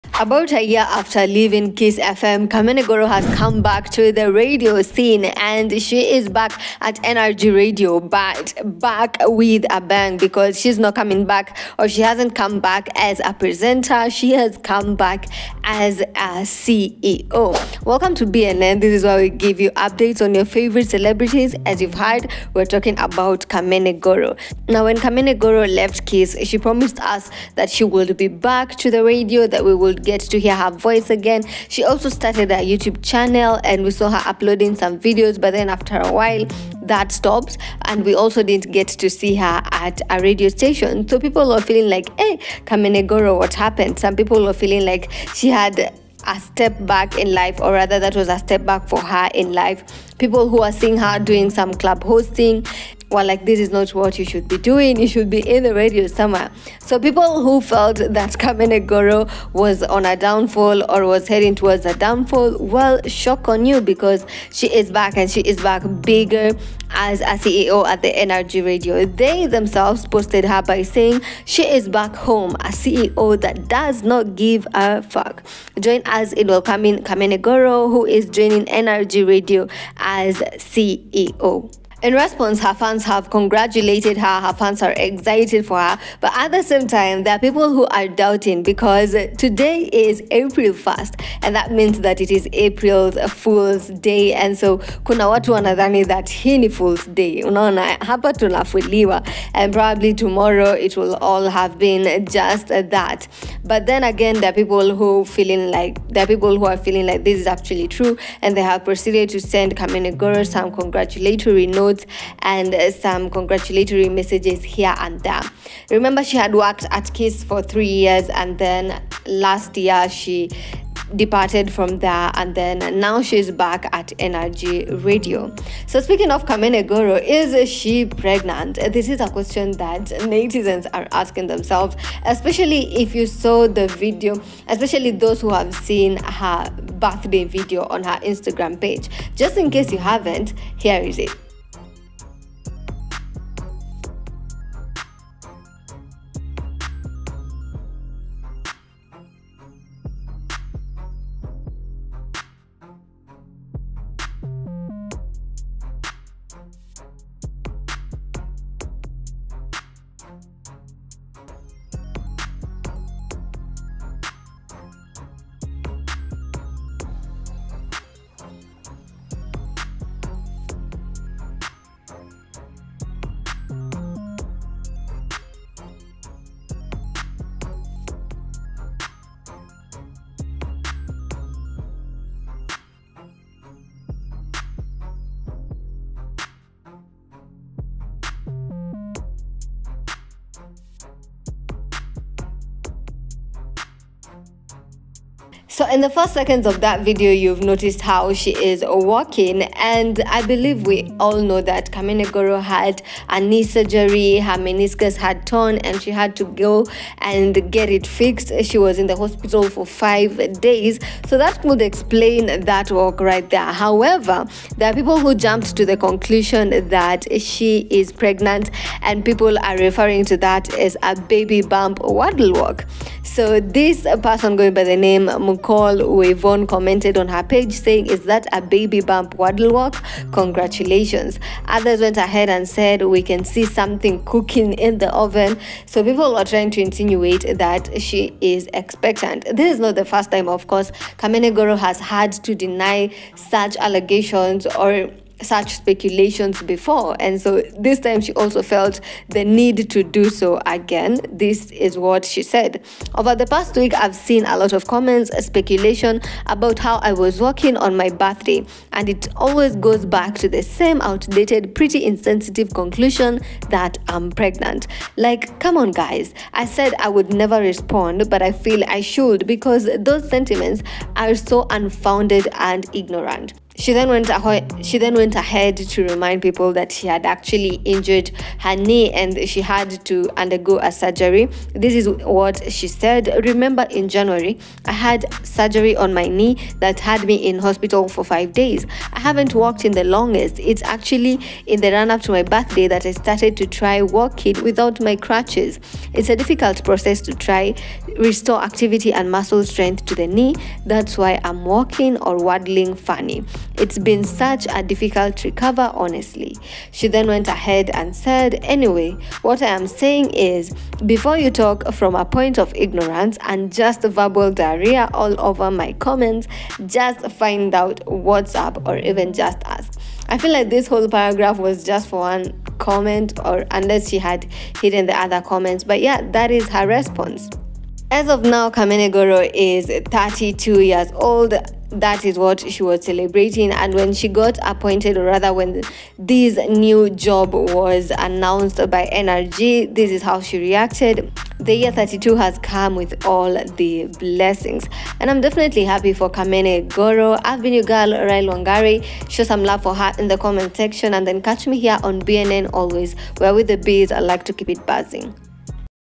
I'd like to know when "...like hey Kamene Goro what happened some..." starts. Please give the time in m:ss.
0:41.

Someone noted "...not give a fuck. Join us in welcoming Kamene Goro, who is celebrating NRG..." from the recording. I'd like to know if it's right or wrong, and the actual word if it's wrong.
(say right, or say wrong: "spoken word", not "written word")
wrong: "joining", not "celebrating".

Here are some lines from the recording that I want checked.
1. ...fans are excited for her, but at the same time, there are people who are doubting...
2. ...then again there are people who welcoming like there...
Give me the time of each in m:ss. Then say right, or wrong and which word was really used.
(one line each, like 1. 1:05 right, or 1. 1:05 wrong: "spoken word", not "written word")
1. 1:24 right
2. 1:43 wrong: "feeling", not "welcoming".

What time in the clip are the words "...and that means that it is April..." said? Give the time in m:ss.
1:31.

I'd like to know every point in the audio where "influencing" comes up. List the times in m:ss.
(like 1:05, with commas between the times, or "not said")
not said.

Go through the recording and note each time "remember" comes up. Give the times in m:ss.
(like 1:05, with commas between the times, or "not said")
1:55, 4:43.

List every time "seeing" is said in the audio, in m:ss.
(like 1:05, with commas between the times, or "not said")
0:50.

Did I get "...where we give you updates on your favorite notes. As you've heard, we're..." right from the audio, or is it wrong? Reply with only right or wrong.
wrong.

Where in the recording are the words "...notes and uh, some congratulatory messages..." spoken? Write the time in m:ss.
1:51.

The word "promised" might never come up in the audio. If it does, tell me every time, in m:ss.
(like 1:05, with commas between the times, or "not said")
0:26.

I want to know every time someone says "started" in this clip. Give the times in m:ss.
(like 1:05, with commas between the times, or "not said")
0:32, 4:53.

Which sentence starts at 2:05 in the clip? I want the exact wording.
So, speaking of Kamene Goro, is she pregnant?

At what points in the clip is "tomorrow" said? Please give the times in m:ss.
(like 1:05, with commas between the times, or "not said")
1:40.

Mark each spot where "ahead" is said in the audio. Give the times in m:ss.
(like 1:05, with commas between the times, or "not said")
3:52, 4:35, 5:07.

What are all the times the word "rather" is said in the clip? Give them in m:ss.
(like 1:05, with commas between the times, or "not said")
0:47, 5:35.